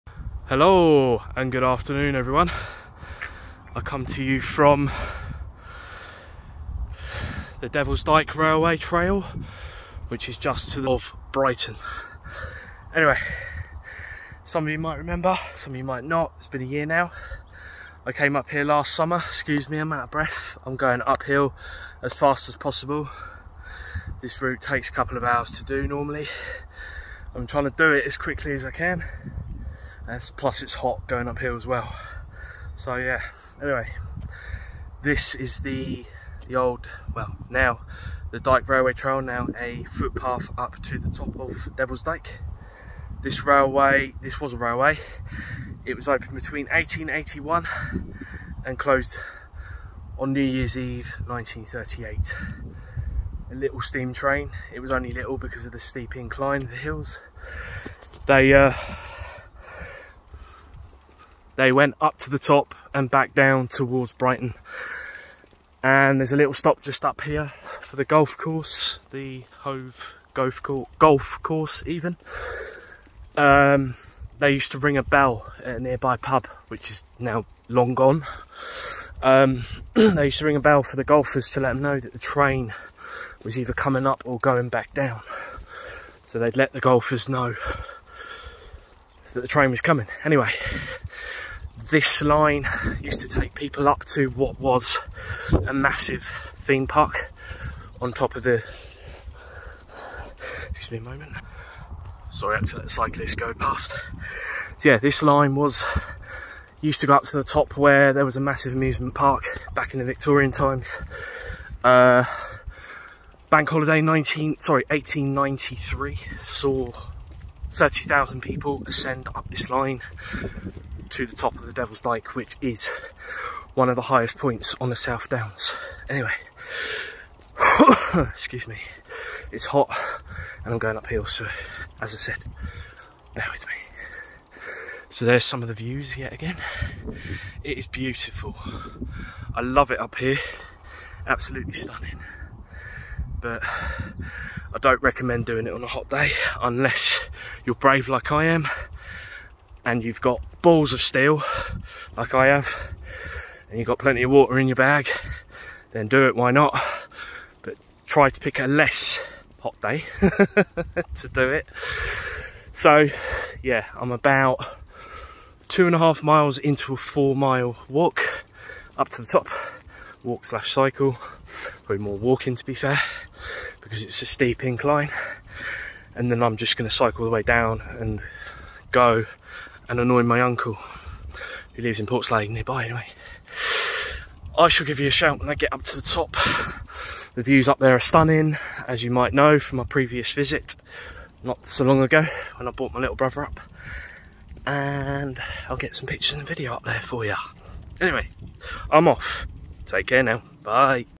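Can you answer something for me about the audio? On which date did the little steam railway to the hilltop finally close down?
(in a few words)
New Year's Eve 1938.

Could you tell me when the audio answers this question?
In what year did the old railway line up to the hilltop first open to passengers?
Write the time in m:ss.
0:46.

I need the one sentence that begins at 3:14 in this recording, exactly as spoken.
And I'll get some pictures and video up there for you.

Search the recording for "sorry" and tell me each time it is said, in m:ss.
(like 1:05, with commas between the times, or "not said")
1:42, 1:54.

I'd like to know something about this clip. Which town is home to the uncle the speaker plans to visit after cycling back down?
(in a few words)
Portslade.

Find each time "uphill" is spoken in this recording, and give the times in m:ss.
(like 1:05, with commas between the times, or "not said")
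0:21, 0:31, 2:10.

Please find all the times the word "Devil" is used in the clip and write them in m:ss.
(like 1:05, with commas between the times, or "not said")
0:07, 0:41, 2:01.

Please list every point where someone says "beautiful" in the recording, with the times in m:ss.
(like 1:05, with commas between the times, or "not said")
2:17.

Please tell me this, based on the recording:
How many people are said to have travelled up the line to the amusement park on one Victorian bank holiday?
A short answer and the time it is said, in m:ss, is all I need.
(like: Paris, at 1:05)
30,000, at 1:57.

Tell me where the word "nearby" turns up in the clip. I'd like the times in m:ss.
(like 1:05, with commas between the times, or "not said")
1:15, 3:02.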